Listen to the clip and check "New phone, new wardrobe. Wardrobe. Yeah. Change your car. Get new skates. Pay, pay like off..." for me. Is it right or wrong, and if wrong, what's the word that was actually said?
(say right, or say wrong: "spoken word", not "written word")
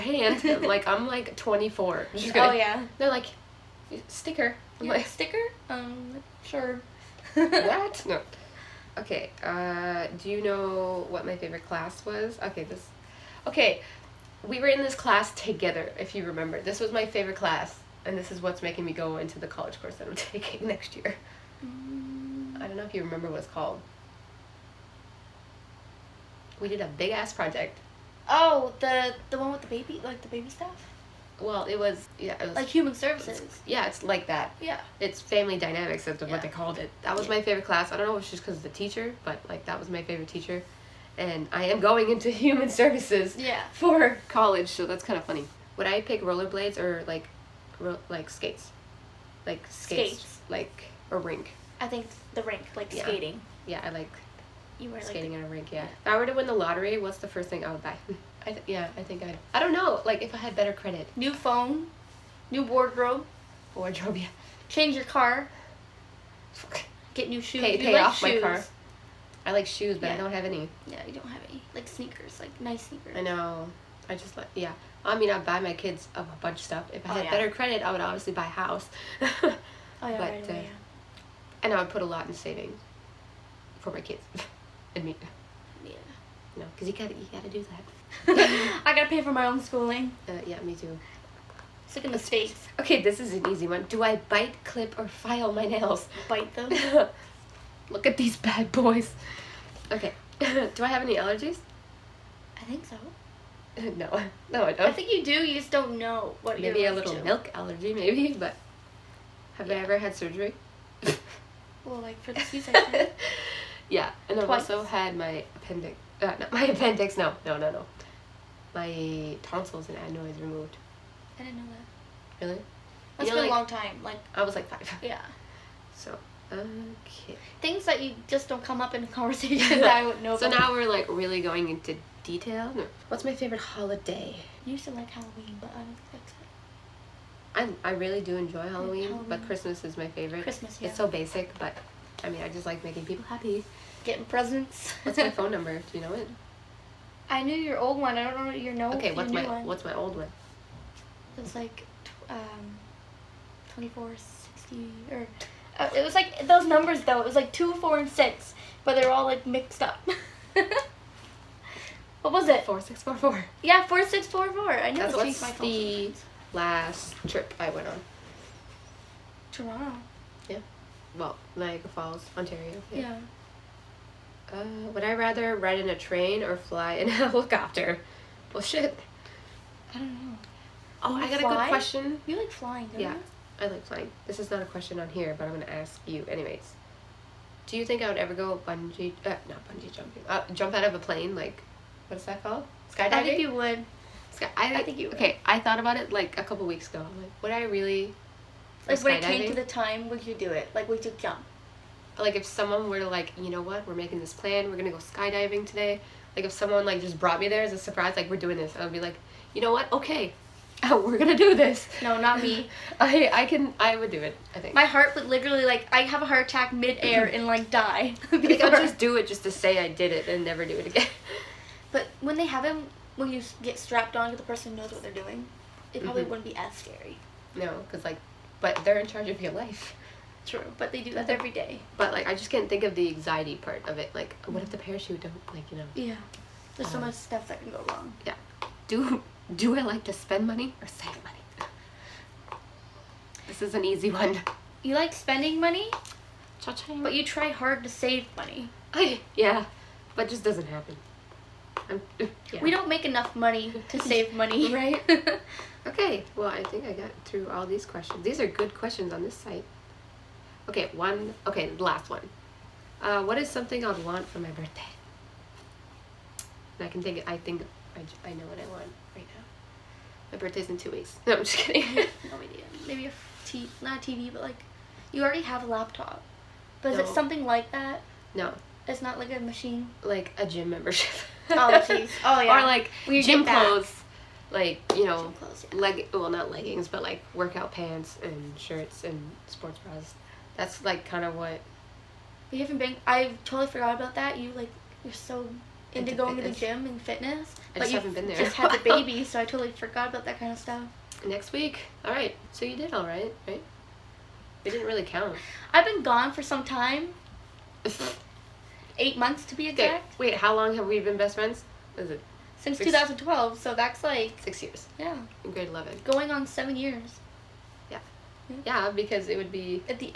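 wrong: "shoes", not "skates".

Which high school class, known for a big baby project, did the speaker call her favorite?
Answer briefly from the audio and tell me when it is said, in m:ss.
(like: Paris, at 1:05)
Family dynamics, at 0:35.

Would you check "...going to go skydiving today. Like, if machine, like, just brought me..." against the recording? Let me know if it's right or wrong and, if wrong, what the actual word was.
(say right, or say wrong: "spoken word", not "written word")
wrong: "someone", not "machine".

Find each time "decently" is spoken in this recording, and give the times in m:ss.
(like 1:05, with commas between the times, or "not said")
not said.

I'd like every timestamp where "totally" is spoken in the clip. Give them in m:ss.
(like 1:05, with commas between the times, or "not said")
4:53, 4:59.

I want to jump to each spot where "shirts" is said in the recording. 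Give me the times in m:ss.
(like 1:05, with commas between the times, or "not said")
4:48.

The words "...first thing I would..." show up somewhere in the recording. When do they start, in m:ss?
0:57.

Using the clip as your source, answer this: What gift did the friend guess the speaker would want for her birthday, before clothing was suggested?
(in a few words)
A gym membership.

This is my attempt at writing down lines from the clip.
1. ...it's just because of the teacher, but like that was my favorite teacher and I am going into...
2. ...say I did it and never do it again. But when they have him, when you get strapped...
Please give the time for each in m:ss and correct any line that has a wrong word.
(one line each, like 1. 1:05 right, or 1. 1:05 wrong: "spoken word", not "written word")
1. 0:38 right
2. 3:39 right.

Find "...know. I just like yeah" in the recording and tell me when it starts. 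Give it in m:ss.
1:13.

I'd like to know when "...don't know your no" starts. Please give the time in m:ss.
2:28.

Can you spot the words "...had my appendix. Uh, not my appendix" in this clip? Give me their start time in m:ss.
1:54.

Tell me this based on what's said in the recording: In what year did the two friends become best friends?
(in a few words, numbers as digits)
2012.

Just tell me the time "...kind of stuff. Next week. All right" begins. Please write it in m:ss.
5:00.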